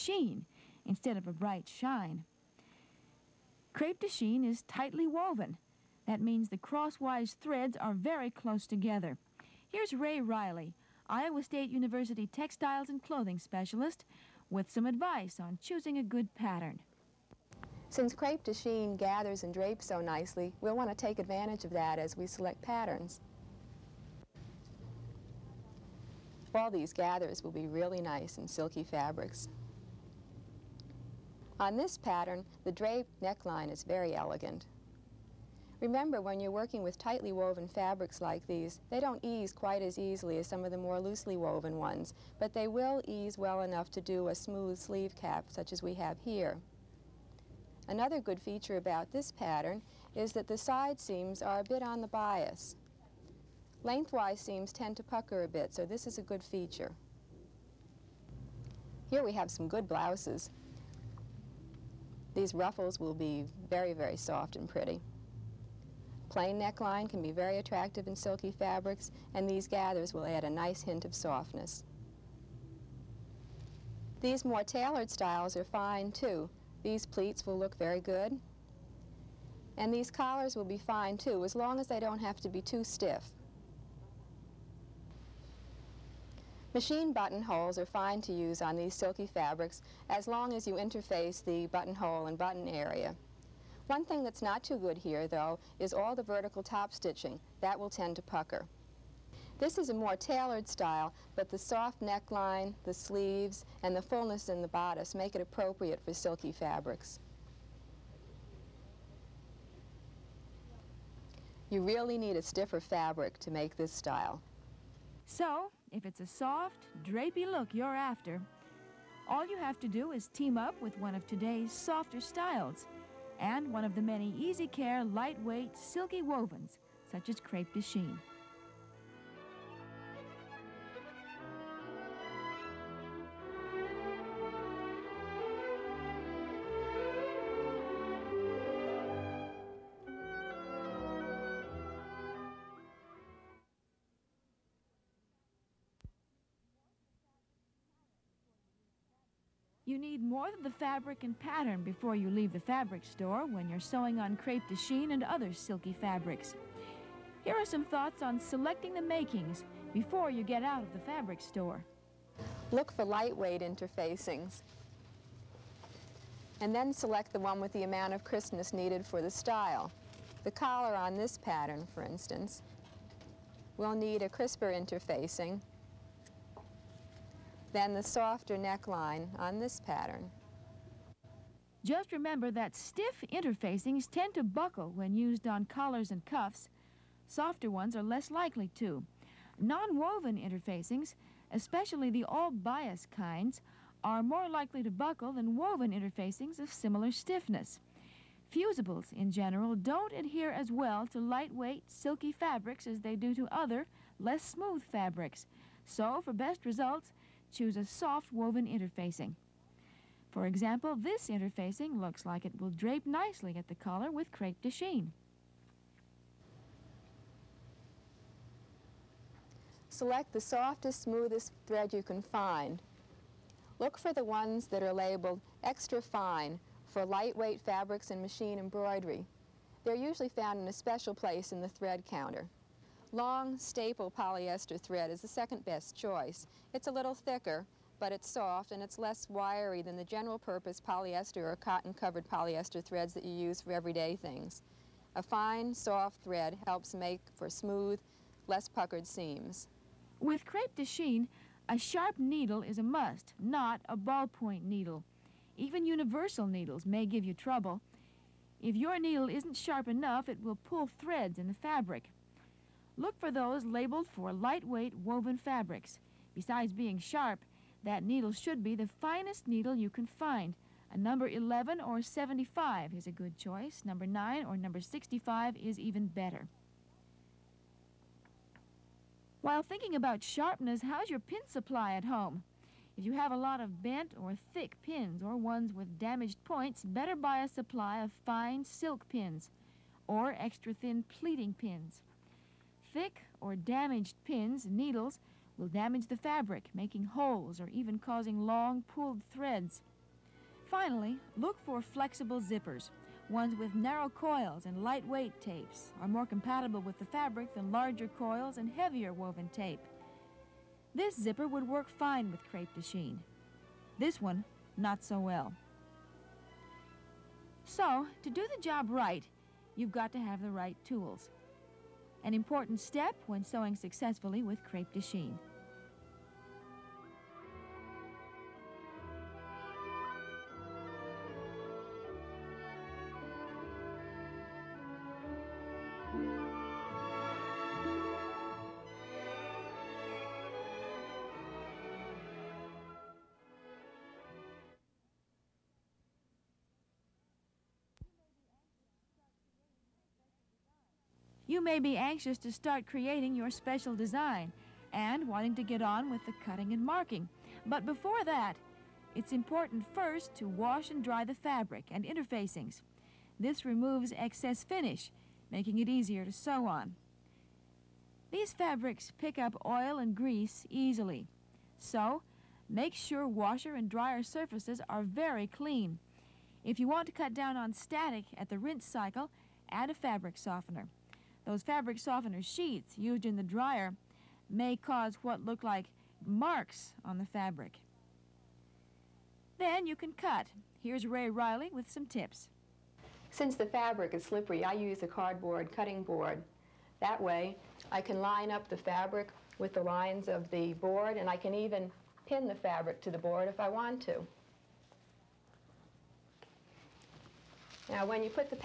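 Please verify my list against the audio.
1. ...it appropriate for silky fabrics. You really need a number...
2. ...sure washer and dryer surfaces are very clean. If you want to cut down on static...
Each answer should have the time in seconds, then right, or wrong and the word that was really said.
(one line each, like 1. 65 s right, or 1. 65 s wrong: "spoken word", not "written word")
1. 105 s wrong: "stiffer", not "number"
2. 372 s right.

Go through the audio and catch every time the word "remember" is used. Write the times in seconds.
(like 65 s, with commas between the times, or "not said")
35 s, 182 s.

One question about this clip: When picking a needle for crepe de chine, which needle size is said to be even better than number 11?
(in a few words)
Number 9.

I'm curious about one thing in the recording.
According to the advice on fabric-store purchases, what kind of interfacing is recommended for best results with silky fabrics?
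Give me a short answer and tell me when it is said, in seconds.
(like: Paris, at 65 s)
soft woven interfacing, at 207 s.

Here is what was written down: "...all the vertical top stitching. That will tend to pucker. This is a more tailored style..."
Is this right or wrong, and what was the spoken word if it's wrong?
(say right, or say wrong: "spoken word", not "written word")
right.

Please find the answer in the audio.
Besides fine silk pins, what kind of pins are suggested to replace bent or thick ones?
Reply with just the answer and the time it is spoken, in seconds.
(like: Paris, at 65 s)
extra thin pleating pins, at 290 s.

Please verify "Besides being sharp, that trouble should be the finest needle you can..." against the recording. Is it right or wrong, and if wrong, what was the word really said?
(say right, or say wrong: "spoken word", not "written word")
wrong: "needle", not "trouble".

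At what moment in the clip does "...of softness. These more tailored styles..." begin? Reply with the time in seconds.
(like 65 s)
71 s.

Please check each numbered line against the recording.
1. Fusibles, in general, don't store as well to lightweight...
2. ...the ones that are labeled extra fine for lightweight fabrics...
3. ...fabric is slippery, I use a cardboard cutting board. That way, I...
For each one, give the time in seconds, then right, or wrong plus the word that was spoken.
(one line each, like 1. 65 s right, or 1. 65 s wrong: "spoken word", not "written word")
1. 198 s wrong: "adhere", not "store"
2. 224 s right
3. 393 s right.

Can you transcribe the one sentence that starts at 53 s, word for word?
Lengthwise seams tend to pucker a bit, so this is a good feature.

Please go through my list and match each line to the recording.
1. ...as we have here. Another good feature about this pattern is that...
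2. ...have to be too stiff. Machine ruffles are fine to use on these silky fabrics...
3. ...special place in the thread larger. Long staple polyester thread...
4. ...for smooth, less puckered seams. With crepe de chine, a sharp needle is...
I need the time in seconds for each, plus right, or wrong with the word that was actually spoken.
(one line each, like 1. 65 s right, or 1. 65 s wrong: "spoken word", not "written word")
1. 45 s right
2. 82 s wrong: "buttonholes", not "ruffles"
3. 230 s wrong: "counter", not "larger"
4. 247 s right.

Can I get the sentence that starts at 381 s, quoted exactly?
Those fabric softener sheets used in the dryer may cause what look like marks on the fabric.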